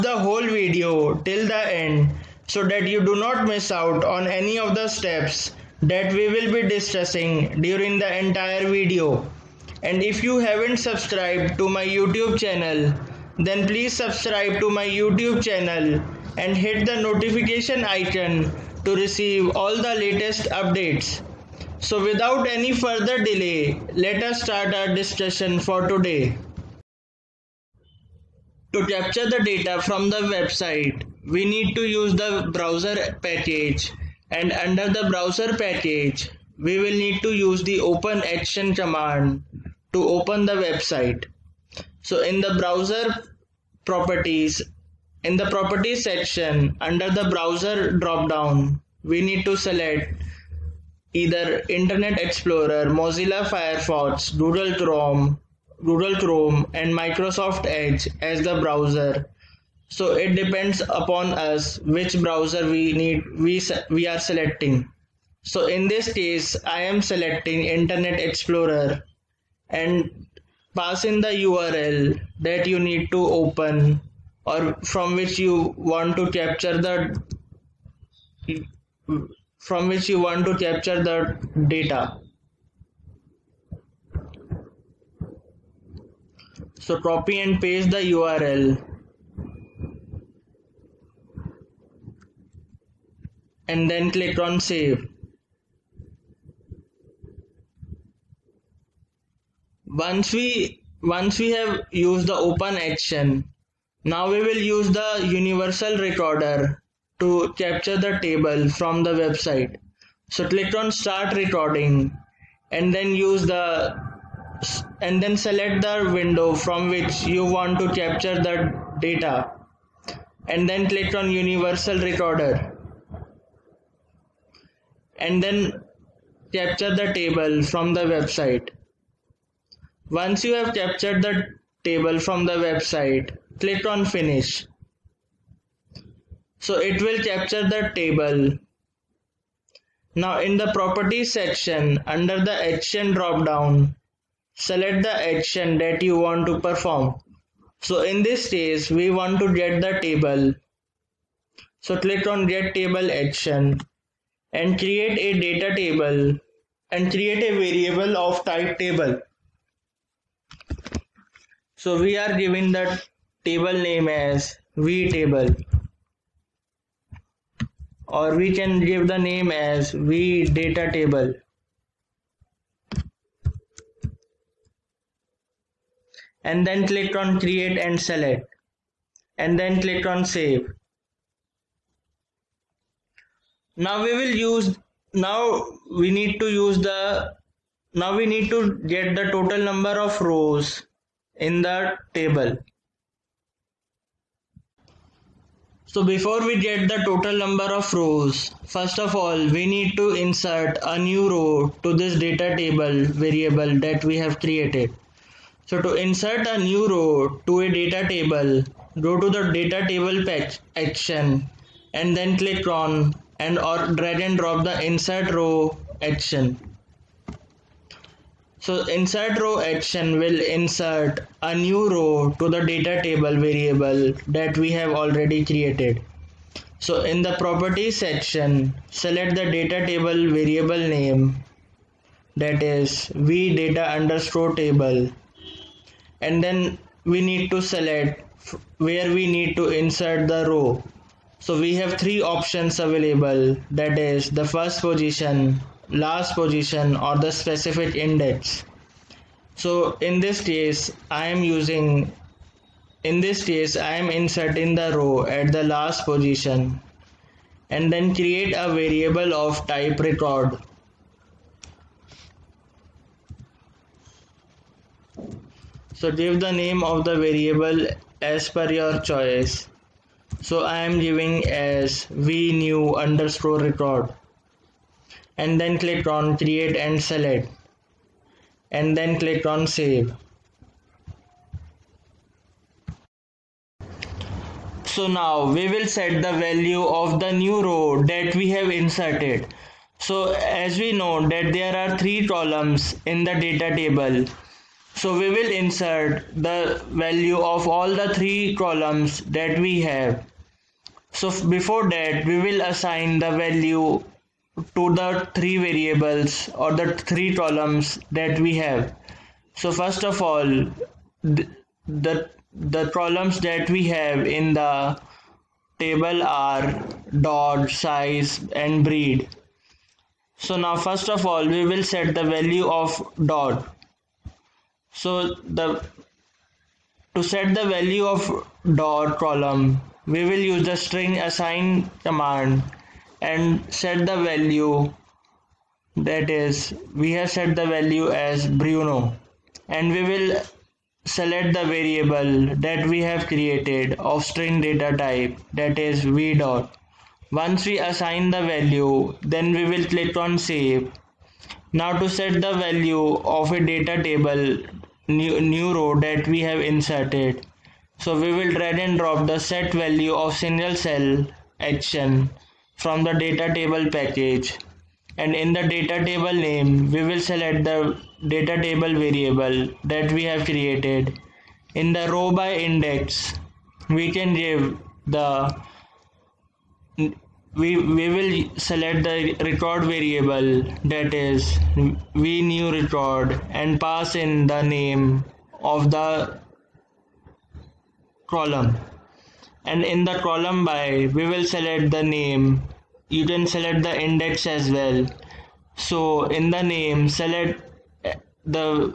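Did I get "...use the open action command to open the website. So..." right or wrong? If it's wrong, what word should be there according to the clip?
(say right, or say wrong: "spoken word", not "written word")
right.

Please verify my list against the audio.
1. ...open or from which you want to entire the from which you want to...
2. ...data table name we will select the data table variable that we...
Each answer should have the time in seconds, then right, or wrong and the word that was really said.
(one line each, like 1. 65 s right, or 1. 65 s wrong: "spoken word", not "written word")
1. 73 s wrong: "capture", not "entire"
2. 365 s right.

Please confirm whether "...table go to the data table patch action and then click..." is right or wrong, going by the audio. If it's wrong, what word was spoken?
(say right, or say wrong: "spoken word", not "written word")
right.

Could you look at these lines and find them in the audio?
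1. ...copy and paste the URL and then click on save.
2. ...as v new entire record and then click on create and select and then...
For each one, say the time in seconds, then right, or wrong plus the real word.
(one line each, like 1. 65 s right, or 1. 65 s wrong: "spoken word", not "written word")
1. 86 s right
2. 271 s wrong: "underscore", not "entire".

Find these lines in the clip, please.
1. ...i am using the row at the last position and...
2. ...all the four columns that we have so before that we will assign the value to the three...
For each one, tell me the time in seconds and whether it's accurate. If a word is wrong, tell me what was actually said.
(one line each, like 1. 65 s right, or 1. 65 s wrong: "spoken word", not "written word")
1. 253 s wrong: "inserting", not "using"
2. 297 s wrong: "three", not "four".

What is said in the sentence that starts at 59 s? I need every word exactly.
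So it depends upon us which browser we need we we are selecting.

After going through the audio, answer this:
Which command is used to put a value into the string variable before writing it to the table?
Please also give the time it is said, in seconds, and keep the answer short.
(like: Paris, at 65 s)
string assign, at 330 s.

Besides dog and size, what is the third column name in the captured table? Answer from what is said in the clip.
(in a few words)
breed.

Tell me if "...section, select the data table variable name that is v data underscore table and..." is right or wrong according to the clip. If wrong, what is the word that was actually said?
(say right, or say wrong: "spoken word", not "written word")
right.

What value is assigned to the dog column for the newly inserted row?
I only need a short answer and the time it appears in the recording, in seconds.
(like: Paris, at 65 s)
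Bruno, at 338 s.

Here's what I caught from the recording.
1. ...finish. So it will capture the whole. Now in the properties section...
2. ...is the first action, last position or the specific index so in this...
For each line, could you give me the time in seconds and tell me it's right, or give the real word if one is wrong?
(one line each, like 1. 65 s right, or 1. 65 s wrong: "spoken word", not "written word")
1. 134 s wrong: "table", not "whole"
2. 243 s wrong: "position", not "action".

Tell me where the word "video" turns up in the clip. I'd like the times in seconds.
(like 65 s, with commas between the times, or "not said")
0 s, 8 s.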